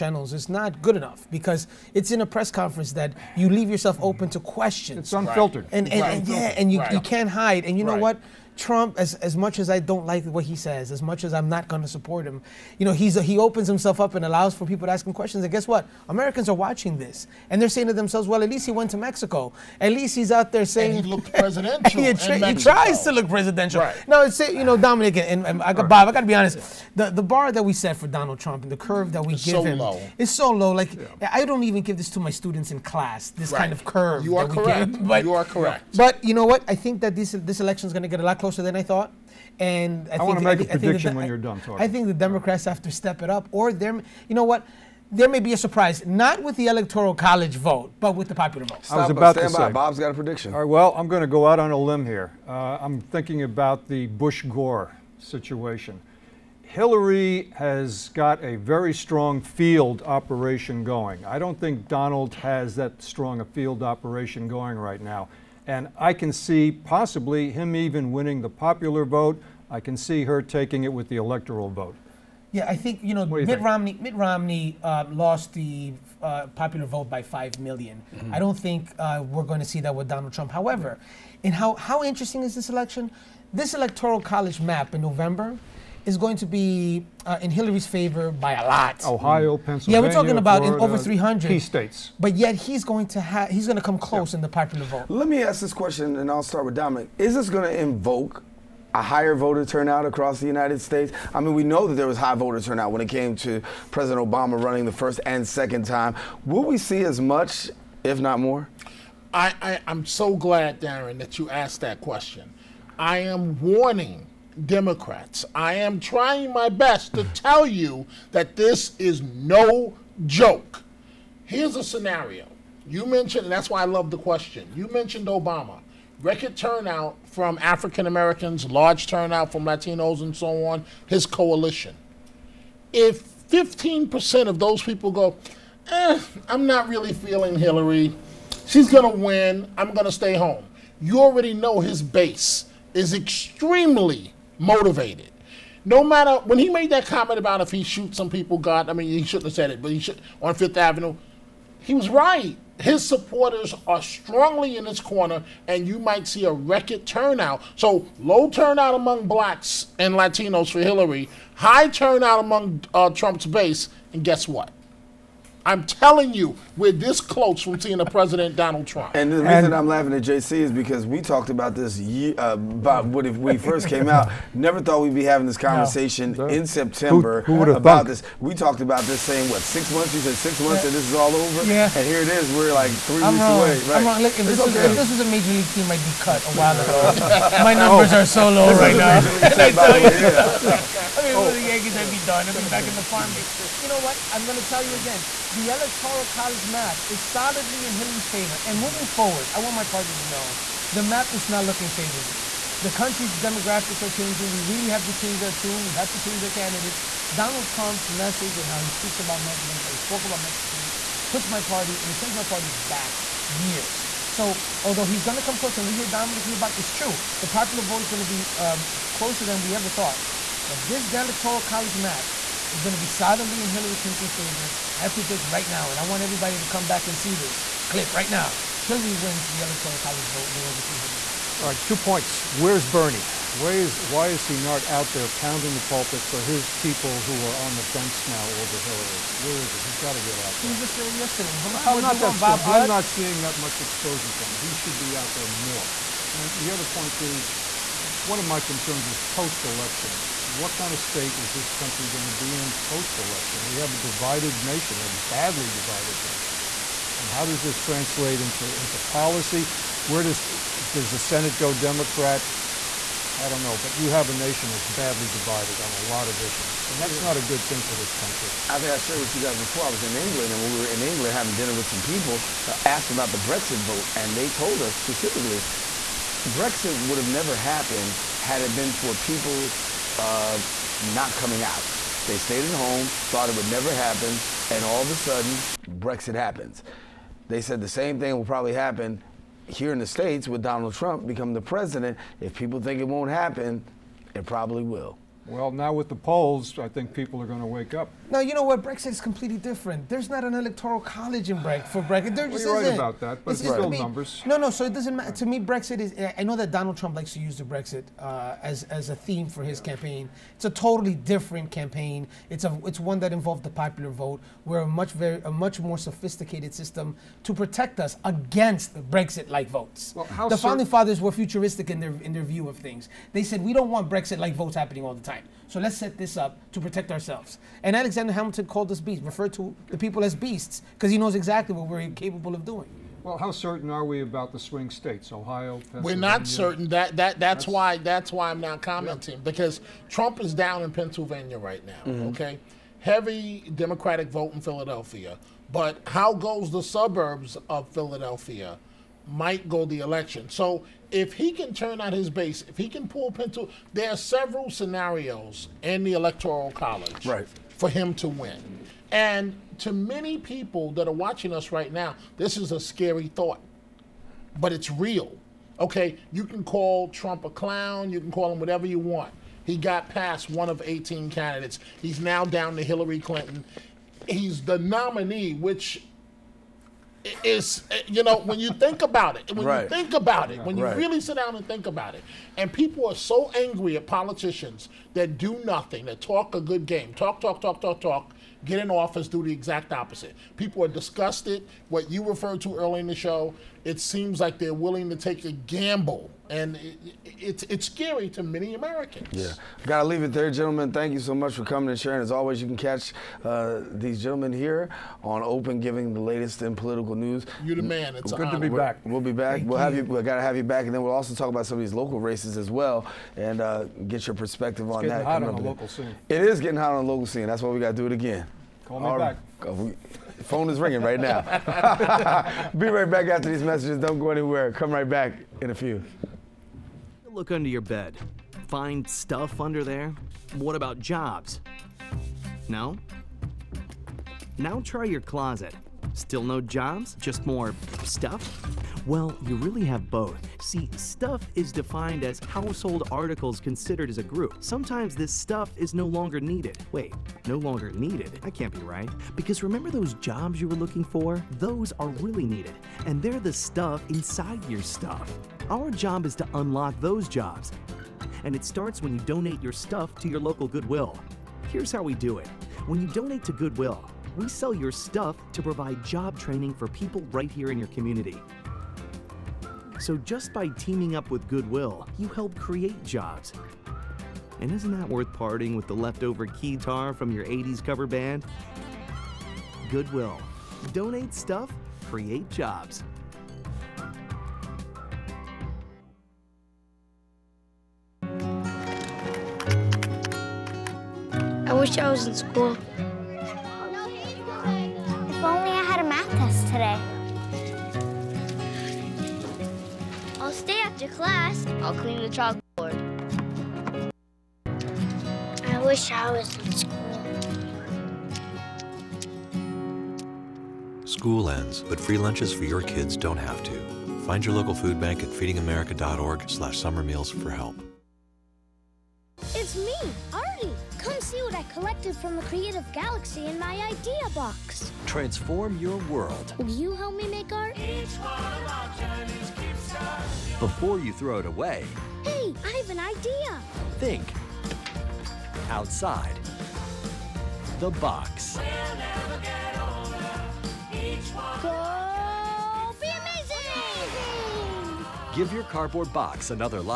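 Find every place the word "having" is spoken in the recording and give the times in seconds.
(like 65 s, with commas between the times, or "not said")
175 s, 271 s.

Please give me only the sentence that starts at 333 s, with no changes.
Well, how certain are we about the swing states, Ohio?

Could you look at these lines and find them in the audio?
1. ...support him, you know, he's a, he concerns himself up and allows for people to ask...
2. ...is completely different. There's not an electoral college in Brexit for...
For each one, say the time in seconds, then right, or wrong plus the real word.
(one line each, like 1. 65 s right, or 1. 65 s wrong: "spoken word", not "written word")
1. 11 s wrong: "opens", not "concerns"
2. 299 s right.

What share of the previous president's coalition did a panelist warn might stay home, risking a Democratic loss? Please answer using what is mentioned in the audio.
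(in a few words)
15%.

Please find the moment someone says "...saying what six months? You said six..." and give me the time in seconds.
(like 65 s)
179 s.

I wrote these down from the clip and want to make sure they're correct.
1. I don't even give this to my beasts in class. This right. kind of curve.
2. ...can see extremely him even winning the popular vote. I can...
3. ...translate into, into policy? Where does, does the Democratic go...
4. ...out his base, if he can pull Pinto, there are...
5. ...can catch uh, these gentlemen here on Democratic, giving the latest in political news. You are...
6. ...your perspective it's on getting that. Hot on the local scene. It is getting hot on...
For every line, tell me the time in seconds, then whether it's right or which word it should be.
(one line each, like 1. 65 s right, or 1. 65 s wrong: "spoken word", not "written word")
1. 31 s wrong: "students", not "beasts"
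2. 66 s wrong: "possibly", not "extremely"
3. 257 s wrong: "Senate", not "Democratic"
4. 351 s right
5. 402 s wrong: "Open", not "Democratic"
6. 414 s right.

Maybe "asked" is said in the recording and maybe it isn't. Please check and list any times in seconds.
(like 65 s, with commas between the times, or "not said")
111 s, 272 s.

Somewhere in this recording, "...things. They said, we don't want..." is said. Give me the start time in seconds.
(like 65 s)
322 s.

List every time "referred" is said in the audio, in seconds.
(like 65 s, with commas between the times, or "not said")
329 s, 392 s.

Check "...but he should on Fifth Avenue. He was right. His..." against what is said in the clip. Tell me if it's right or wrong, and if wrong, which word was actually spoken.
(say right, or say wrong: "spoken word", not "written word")
right.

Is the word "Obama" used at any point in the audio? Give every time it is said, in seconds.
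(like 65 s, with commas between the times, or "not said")
104 s, 125 s.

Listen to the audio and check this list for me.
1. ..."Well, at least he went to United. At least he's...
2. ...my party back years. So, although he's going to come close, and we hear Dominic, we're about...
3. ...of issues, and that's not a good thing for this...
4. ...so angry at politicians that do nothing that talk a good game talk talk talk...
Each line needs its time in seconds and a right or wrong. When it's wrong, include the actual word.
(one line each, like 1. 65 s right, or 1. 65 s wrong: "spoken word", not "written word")
1. 18 s wrong: "Mexico", not "United"
2. 212 s right
3. 266 s right
4. 383 s right.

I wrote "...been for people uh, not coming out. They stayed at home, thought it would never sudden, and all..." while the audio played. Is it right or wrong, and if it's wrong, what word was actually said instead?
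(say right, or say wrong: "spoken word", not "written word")
wrong: "happen", not "sudden".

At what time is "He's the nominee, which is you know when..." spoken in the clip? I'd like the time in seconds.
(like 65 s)
374 s.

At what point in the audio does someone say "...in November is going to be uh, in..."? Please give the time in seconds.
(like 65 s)
84 s.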